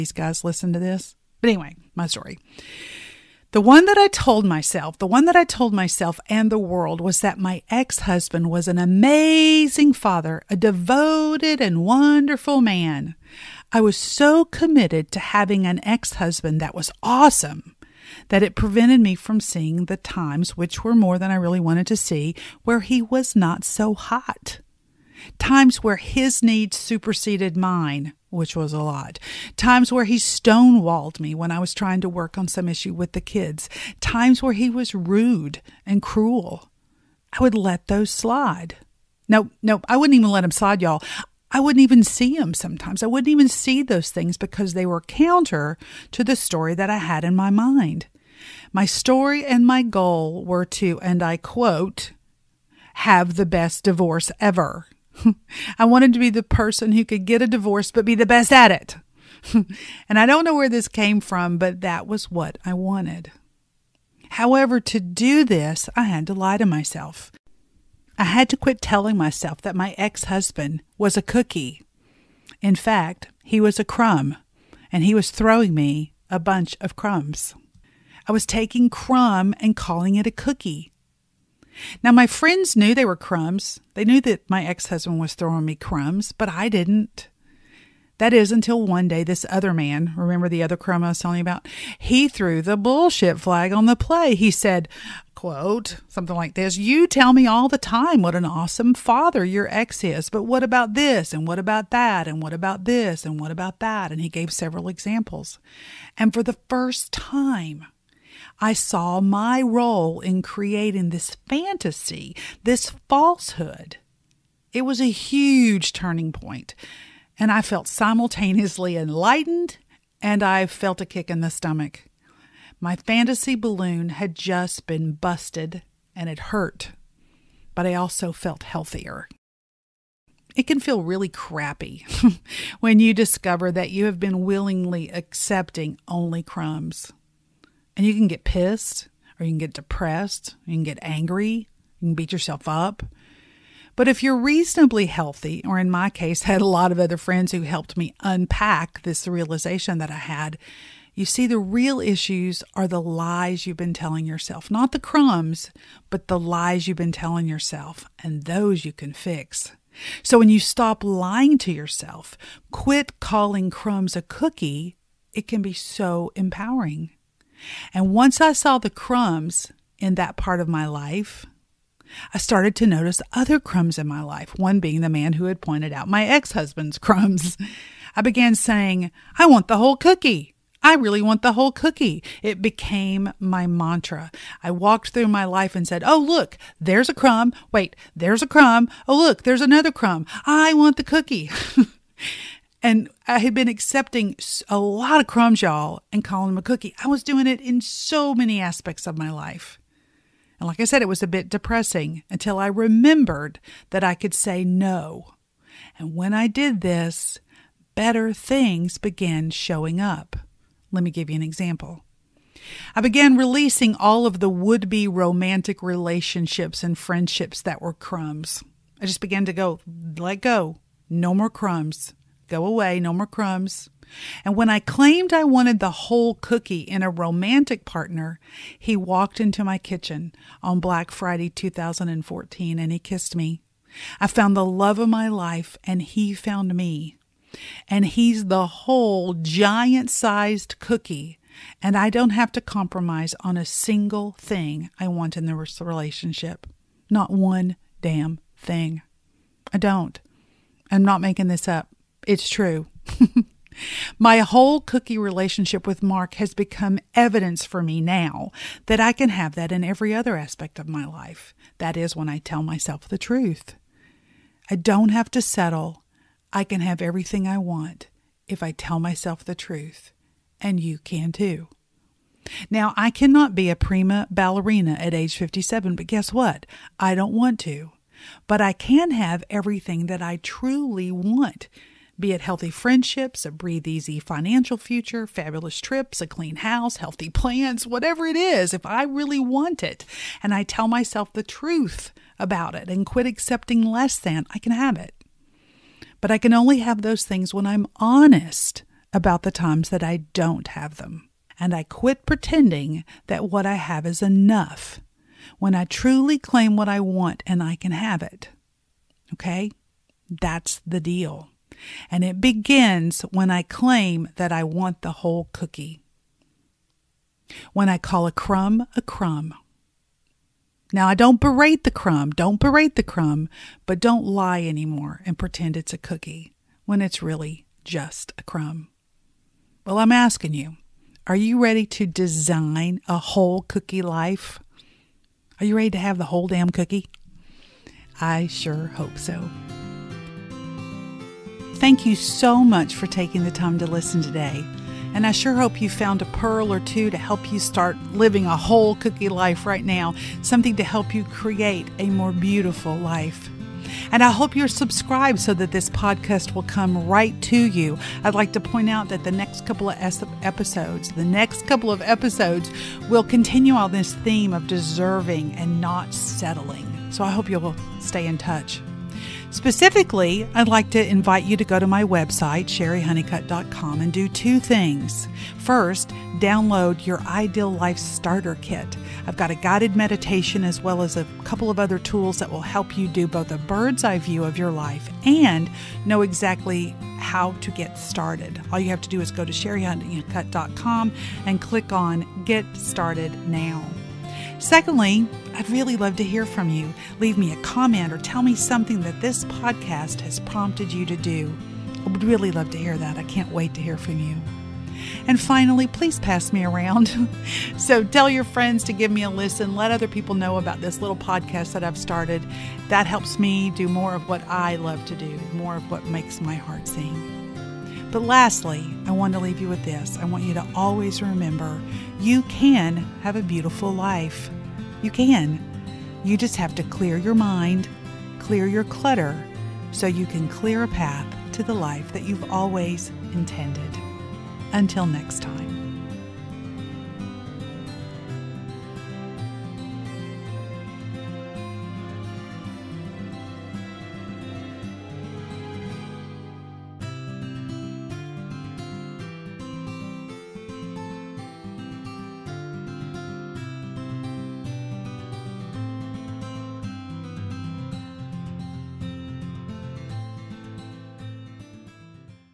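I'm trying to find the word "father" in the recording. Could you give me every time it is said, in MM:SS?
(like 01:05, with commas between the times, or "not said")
00:09, 01:38.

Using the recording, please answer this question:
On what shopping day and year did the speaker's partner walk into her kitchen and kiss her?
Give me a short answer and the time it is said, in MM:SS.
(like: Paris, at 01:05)
Black Friday 2014, at 03:50.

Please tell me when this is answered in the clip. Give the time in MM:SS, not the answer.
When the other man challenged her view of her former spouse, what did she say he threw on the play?
01:32.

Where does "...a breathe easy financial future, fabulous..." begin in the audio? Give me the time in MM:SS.
04:43.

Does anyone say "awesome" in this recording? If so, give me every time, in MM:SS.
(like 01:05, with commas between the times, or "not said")
00:17, 01:38.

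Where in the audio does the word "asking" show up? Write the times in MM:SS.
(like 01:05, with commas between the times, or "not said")
05:30.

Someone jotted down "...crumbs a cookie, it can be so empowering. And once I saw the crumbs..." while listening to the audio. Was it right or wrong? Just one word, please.
right.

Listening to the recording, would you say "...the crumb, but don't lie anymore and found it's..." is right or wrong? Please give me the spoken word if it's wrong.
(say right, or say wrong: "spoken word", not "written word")
wrong: "pretend", not "found".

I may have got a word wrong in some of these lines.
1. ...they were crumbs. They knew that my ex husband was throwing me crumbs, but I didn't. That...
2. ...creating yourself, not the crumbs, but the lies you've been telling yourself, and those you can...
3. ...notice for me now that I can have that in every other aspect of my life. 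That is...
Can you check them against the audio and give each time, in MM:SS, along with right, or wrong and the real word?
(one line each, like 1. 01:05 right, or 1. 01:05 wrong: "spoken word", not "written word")
1. 01:22 right
2. 02:33 wrong: "telling", not "creating"
3. 04:17 wrong: "evidence", not "notice".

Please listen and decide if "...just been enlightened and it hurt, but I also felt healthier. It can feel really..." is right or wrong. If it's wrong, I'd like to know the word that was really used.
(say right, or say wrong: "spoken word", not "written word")
wrong: "busted", not "enlightened".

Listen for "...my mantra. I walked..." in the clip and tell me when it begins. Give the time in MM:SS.
03:03.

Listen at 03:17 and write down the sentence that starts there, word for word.
I was doing it in so many aspects of my life.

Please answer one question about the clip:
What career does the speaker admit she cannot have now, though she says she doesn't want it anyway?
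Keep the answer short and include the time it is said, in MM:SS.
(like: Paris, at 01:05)
prima ballerina, at 04:33.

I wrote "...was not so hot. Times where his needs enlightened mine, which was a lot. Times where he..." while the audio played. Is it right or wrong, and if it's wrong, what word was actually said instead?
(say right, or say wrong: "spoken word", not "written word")
wrong: "superseded", not "enlightened".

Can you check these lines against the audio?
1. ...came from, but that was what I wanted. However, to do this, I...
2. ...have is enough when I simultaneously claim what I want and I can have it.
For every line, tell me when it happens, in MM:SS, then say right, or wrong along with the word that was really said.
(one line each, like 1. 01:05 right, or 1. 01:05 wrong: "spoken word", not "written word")
1. 01:00 right
2. 05:03 wrong: "truly", not "simultaneously".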